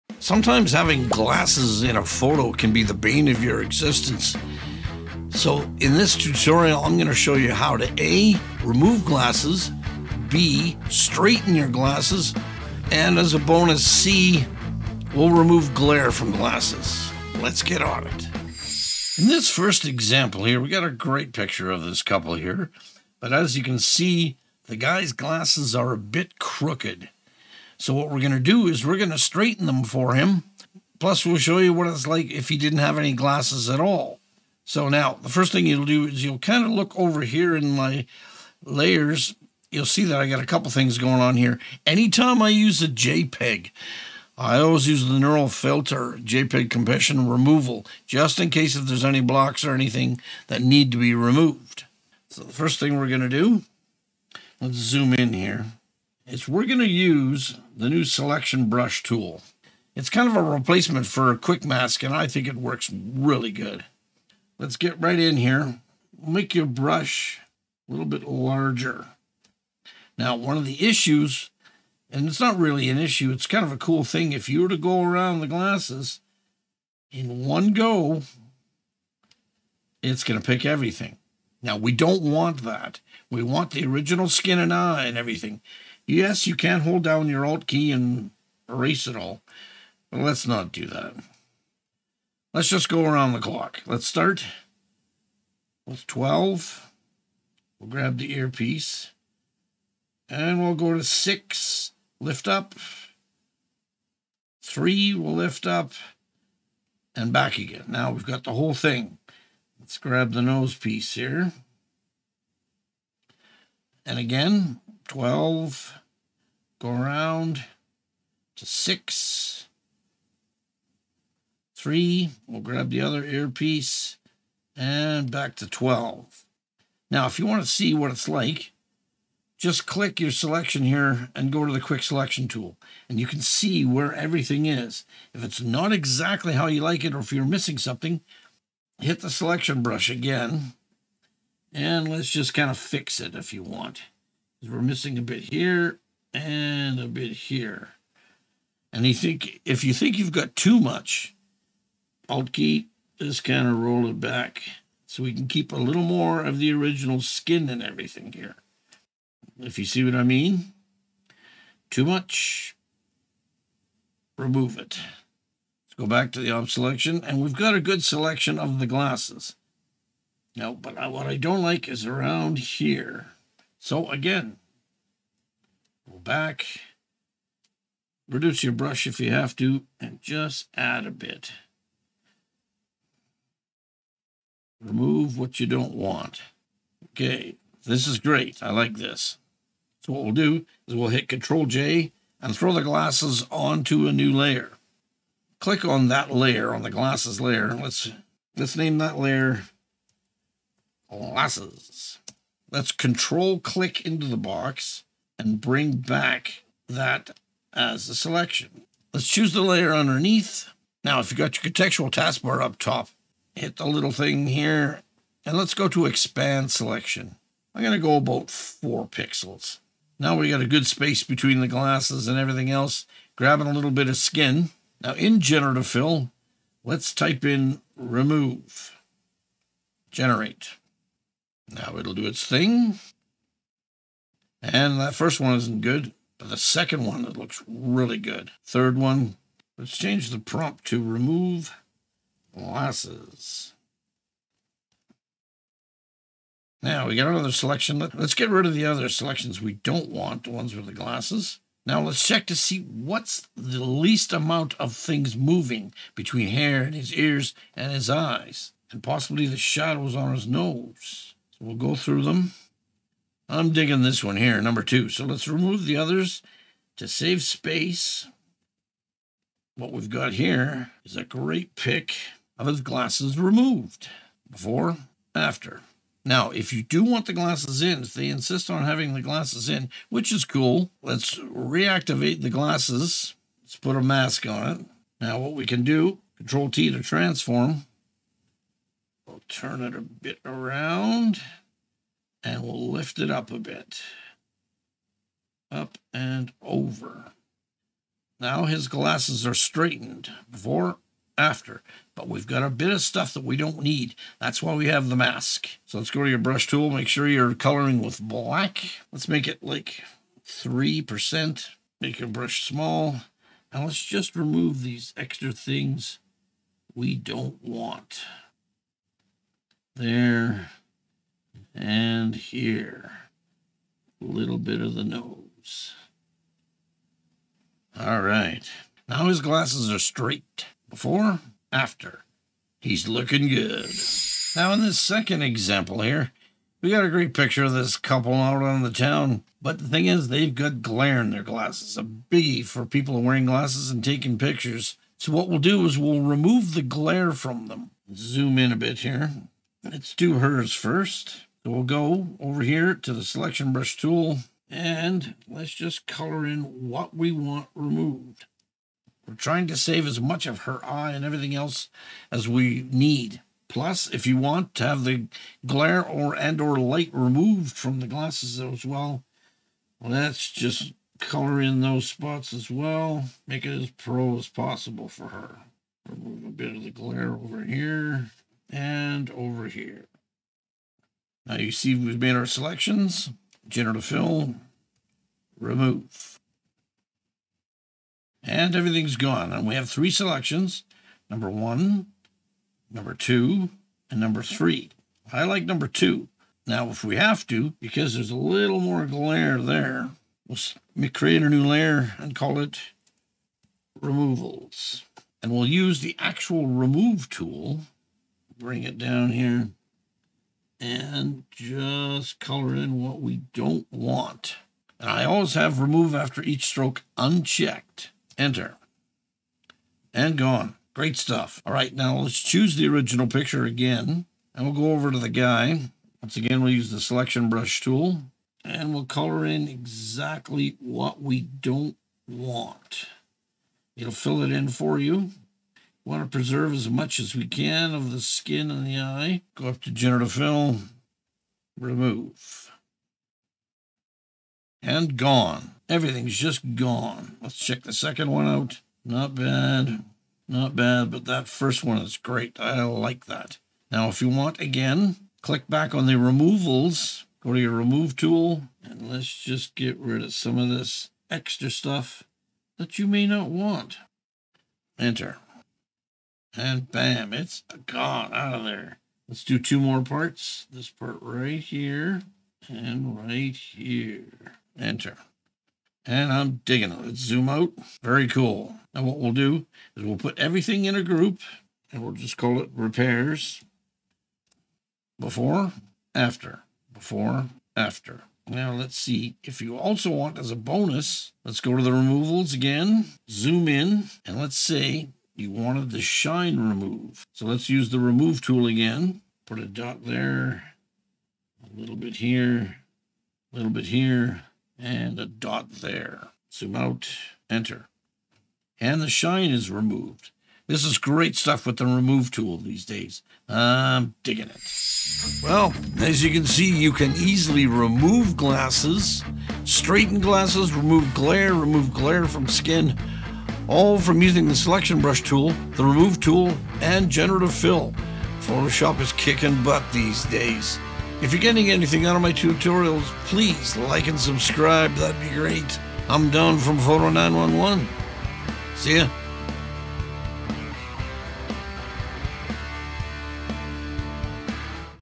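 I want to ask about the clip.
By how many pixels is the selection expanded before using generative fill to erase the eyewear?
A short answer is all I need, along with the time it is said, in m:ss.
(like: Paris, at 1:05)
4, at 3:38.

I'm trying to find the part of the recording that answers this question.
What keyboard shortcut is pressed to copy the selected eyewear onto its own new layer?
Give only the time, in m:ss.
3:11.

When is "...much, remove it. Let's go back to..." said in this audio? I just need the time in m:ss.
2:42.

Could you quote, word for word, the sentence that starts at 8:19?
Put a dot there, a little bit here, a little bit here, and a dot there.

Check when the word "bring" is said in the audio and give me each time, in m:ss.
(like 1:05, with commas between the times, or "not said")
3:25, 6:48.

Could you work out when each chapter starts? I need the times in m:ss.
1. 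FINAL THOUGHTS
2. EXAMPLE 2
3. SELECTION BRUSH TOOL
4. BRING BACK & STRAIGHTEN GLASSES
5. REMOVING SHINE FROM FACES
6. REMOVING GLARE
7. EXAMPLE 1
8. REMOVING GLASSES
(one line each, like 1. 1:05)
1. 8:35
2. 5:35
3. 0:52
4. 4:39
5. 8:10
6. 5:50
7. 0:18
8. 3:24.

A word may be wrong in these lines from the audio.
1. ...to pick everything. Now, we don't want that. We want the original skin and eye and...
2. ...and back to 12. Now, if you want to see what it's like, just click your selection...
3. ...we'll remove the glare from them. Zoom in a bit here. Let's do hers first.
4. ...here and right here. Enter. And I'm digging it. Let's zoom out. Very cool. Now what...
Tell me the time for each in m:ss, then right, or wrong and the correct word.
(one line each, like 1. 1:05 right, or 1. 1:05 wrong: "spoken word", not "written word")
1. 1:20 right
2. 2:04 right
3. 5:45 right
4. 7:51 right.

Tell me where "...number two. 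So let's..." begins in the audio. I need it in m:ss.
4:24.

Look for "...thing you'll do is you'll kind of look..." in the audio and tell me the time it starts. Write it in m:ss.
0:35.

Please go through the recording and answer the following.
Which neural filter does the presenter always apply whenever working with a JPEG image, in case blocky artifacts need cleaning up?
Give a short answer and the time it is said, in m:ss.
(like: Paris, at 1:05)
JPEG compression removal, at 0:46.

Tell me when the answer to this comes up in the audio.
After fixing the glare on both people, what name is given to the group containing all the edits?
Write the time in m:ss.
8:02.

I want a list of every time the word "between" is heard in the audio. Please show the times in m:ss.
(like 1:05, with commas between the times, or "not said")
3:41, 4:16.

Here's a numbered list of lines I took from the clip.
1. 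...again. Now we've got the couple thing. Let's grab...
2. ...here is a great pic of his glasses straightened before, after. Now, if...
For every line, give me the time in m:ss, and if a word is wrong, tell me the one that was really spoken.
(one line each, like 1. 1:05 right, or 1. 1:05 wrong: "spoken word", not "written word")
1. 1:47 wrong: "whole", not "couple"
2. 4:30 wrong: "removed", not "straightened".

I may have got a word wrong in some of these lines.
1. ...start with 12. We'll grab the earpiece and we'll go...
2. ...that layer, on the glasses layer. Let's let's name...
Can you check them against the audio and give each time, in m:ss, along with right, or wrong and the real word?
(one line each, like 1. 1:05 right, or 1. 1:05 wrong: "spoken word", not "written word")
1. 1:34 right
2. 3:16 right.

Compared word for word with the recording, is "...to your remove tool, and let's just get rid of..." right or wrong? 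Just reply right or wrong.
right.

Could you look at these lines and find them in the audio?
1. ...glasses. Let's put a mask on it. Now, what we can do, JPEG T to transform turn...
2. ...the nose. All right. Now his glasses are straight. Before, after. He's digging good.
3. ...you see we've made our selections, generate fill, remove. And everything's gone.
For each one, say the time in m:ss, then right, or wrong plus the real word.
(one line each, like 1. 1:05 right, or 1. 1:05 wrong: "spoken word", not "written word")
1. 4:42 wrong: "Control", not "JPEG"
2. 5:24 wrong: "looking", not "digging"
3. 6:21 right.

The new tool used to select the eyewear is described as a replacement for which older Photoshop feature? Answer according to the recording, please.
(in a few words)
quick mask.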